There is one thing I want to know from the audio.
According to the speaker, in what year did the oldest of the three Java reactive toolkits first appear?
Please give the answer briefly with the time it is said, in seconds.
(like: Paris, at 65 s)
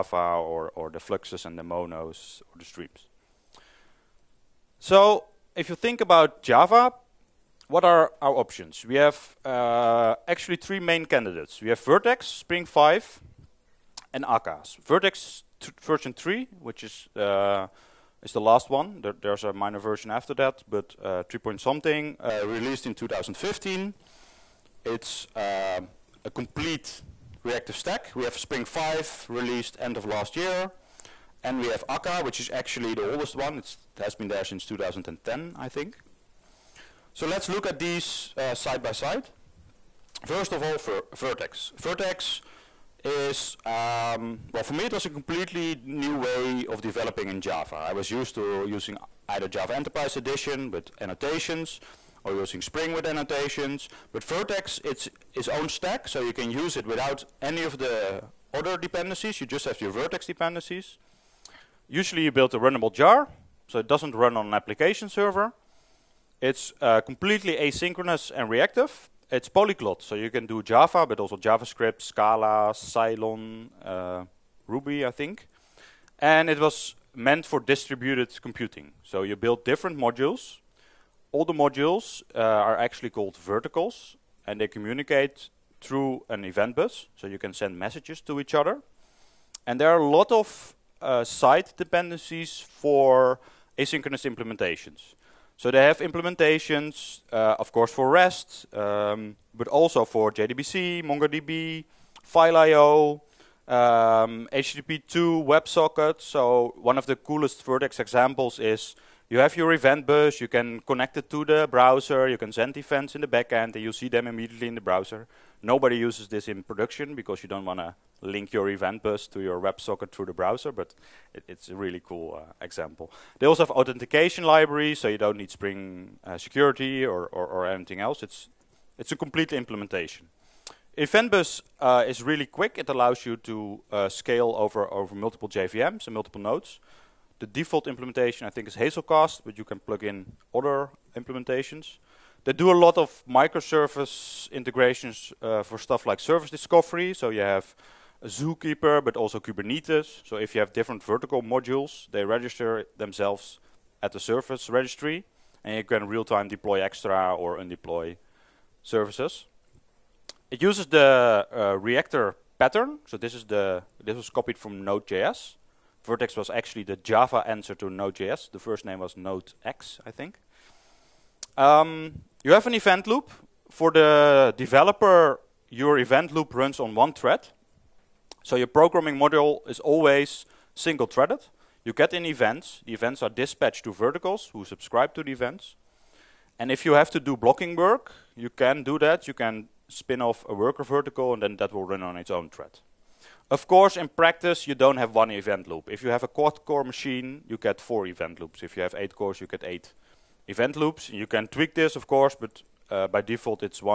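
2010, at 34 s.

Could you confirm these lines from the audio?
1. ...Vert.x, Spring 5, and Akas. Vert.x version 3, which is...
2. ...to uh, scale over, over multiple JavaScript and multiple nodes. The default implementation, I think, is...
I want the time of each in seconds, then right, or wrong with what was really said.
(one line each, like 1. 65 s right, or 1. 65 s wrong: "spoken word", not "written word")
1. 11 s right
2. 133 s wrong: "JVMs", not "JavaScript".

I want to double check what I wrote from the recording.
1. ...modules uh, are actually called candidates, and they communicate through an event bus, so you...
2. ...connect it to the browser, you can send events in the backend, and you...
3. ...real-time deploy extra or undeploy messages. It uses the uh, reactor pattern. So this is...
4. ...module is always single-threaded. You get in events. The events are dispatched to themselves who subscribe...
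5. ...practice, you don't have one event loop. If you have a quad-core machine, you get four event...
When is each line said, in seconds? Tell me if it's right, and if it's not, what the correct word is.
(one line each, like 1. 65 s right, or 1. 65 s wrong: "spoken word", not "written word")
1. 81 s wrong: "verticles", not "candidates"
2. 110 s right
3. 156 s wrong: "services", not "messages"
4. 179 s wrong: "verticles", not "themselves"
5. 194 s right.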